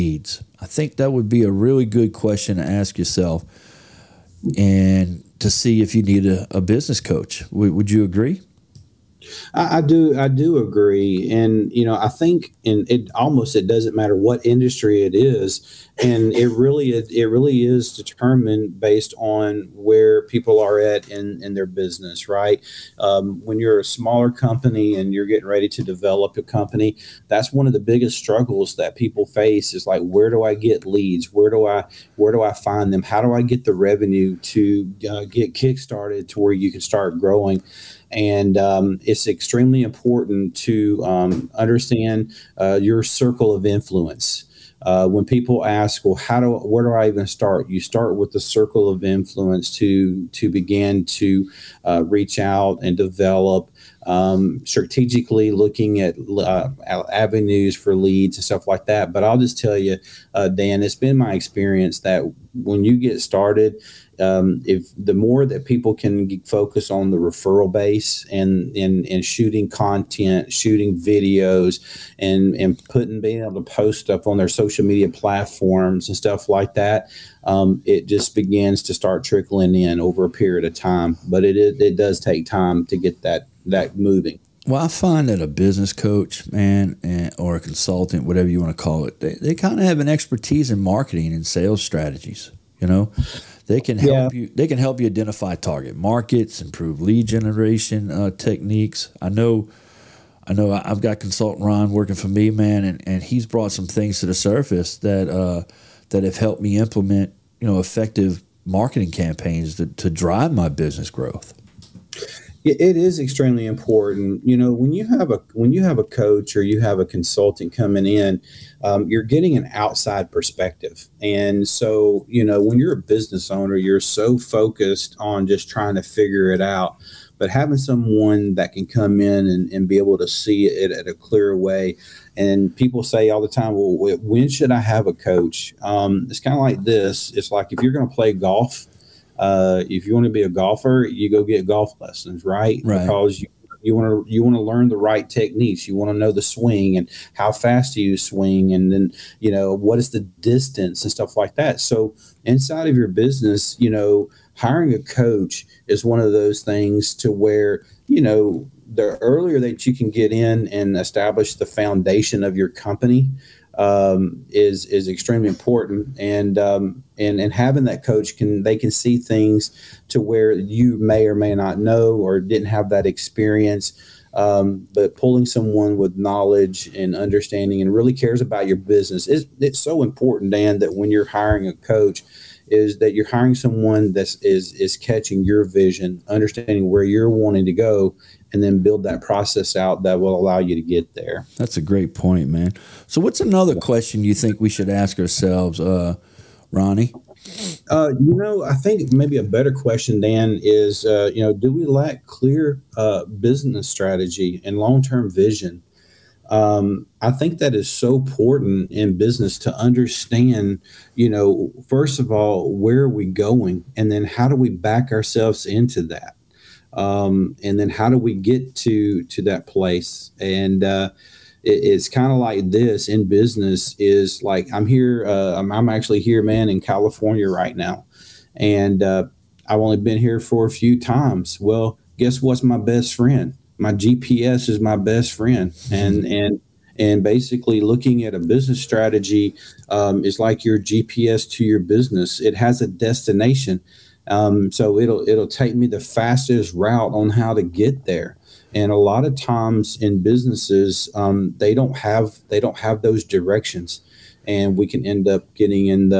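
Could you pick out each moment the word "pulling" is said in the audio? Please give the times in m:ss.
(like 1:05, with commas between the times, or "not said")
2:55.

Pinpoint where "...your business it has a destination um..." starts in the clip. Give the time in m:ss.
4:01.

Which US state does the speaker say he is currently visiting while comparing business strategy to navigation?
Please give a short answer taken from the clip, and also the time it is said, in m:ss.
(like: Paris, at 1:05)
California, at 3:46.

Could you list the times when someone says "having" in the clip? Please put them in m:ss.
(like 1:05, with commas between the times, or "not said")
2:07, 2:47.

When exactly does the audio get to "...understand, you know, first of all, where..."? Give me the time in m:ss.
3:29.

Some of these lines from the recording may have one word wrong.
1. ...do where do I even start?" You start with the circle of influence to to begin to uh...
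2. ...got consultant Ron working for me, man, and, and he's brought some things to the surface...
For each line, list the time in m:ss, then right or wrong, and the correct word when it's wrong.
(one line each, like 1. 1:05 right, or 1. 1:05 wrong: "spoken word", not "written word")
1. 0:46 right
2. 1:41 right.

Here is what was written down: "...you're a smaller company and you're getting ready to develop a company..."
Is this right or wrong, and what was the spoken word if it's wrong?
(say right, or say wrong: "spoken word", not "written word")
right.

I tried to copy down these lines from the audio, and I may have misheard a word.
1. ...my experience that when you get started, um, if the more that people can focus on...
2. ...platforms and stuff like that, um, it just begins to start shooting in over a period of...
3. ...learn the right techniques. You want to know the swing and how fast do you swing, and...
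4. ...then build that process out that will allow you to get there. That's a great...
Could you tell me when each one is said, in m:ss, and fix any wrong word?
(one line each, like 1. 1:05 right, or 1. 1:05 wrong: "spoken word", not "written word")
1. 1:01 right
2. 1:15 wrong: "trickling", not "shooting"
3. 2:24 right
4. 3:08 right.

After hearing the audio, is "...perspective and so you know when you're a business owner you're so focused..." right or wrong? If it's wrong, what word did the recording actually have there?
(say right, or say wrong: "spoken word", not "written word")
right.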